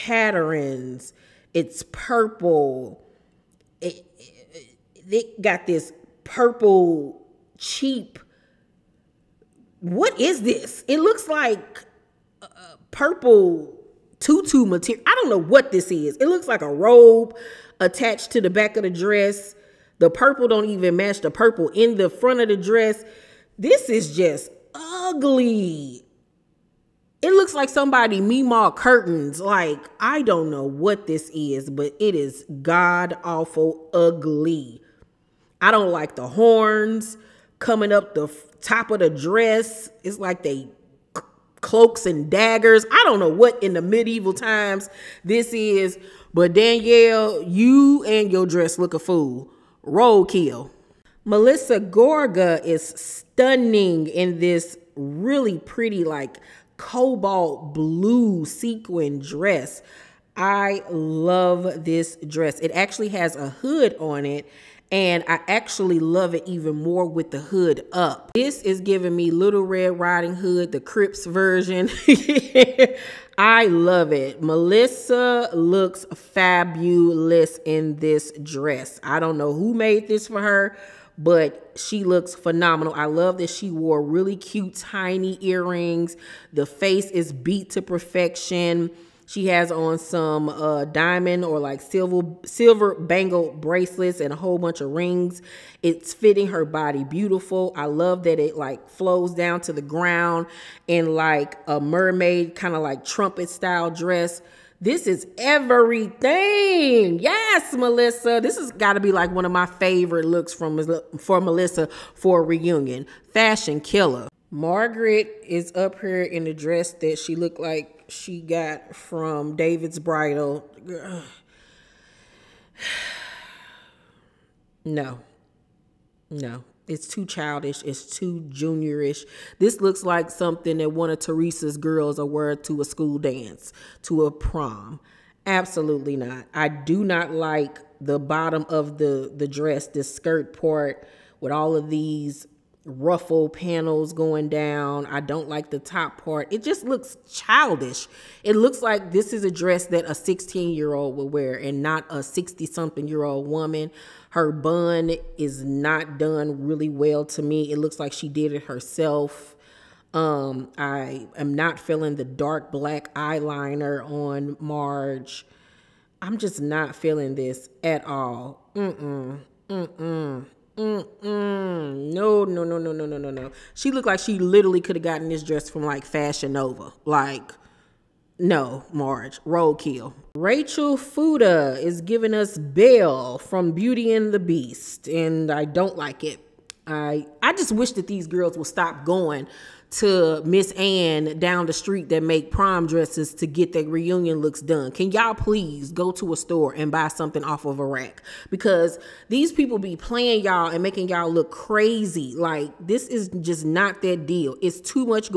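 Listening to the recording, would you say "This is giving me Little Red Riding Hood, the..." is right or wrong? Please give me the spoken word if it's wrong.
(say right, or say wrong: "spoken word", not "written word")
right.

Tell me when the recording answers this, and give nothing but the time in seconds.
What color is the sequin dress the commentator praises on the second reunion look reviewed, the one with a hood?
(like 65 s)
56 s.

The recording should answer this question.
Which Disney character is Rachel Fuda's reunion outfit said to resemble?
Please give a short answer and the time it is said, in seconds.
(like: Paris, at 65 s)
Belle, at 182 s.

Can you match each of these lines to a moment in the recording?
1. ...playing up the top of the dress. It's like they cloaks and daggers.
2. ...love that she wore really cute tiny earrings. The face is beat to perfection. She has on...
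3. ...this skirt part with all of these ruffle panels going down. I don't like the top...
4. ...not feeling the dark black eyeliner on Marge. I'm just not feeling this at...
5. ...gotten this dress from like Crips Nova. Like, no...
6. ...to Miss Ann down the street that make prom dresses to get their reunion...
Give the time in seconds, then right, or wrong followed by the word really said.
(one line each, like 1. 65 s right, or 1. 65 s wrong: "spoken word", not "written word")
1. 37 s wrong: "coming", not "playing"
2. 83 s right
3. 139 s right
4. 161 s right
5. 175 s wrong: "Fashion", not "Crips"
6. 189 s right.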